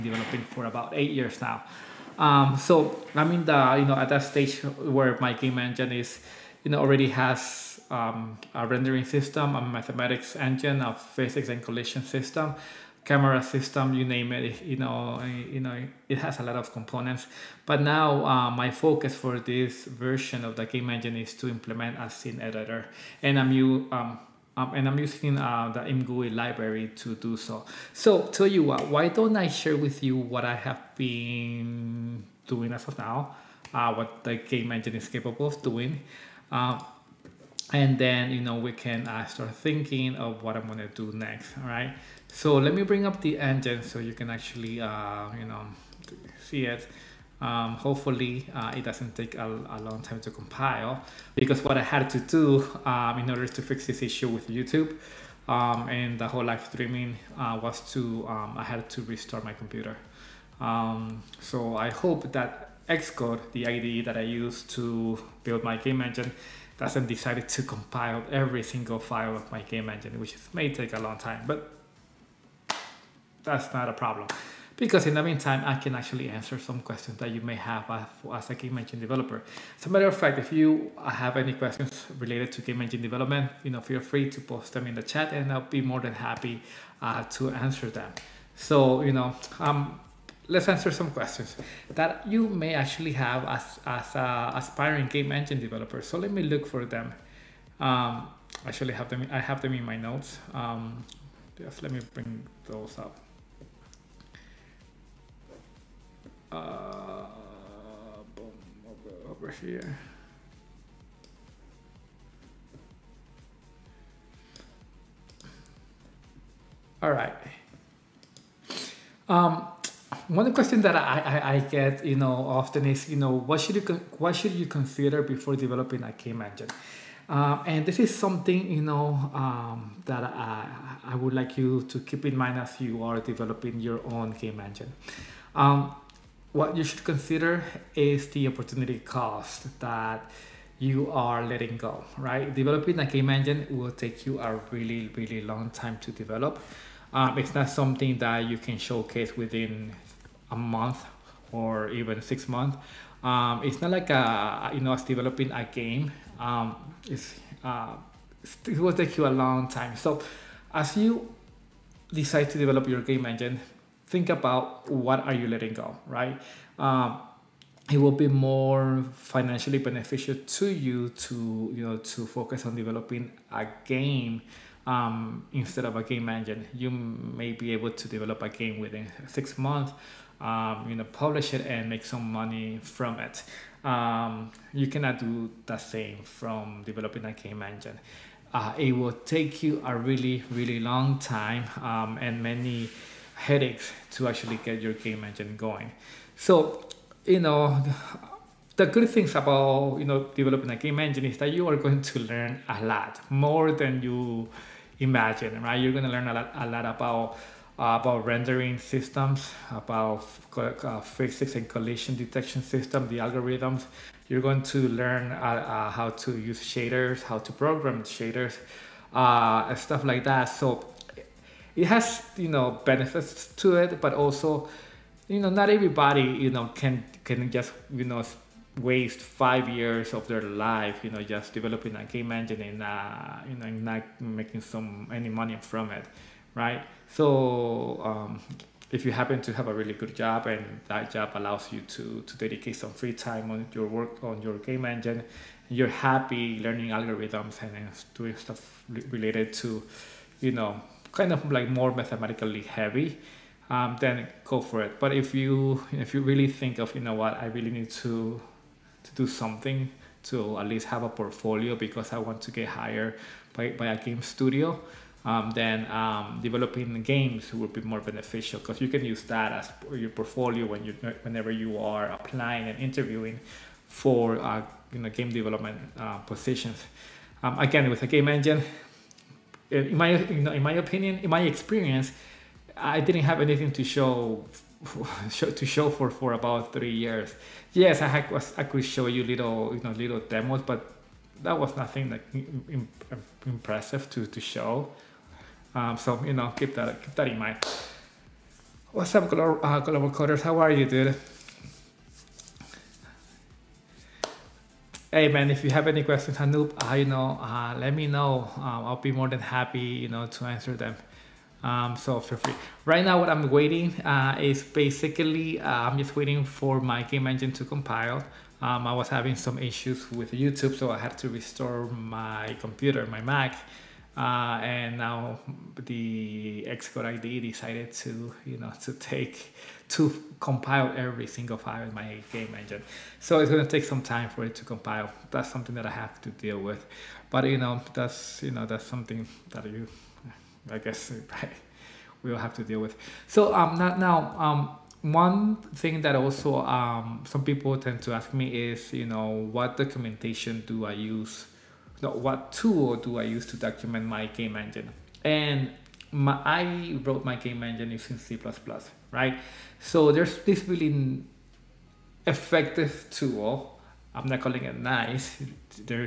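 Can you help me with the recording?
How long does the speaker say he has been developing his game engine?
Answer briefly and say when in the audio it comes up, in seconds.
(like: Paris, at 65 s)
About 8 years, at 0 s.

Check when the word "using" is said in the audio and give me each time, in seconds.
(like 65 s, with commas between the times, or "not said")
24 s, 357 s.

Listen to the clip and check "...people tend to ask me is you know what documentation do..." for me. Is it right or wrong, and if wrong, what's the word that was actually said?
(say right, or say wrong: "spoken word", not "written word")
right.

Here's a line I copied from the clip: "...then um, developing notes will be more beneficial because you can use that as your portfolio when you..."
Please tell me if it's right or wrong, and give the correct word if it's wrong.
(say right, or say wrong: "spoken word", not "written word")
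wrong: "games", not "notes".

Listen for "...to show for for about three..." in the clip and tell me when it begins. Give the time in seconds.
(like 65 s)
285 s.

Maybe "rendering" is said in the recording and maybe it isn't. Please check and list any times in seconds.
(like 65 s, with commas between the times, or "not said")
8 s, 208 s.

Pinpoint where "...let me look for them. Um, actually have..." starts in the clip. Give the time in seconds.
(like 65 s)
96 s.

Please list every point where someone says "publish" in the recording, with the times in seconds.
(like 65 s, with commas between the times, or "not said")
181 s.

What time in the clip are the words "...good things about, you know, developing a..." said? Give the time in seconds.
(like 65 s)
198 s.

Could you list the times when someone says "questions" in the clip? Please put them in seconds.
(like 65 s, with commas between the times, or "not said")
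76 s, 81 s, 91 s, 120 s, 306 s.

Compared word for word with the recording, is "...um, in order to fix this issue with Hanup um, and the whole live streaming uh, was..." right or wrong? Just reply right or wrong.
wrong.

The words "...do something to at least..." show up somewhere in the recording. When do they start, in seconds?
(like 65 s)
259 s.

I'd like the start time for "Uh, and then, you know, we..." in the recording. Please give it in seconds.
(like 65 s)
36 s.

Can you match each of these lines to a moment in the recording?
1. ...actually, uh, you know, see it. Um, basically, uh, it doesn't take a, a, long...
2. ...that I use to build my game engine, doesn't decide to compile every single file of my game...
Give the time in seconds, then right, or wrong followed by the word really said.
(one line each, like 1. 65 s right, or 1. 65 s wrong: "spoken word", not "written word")
1. 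44 s wrong: "hopefully", not "basically"
2. 64 s right.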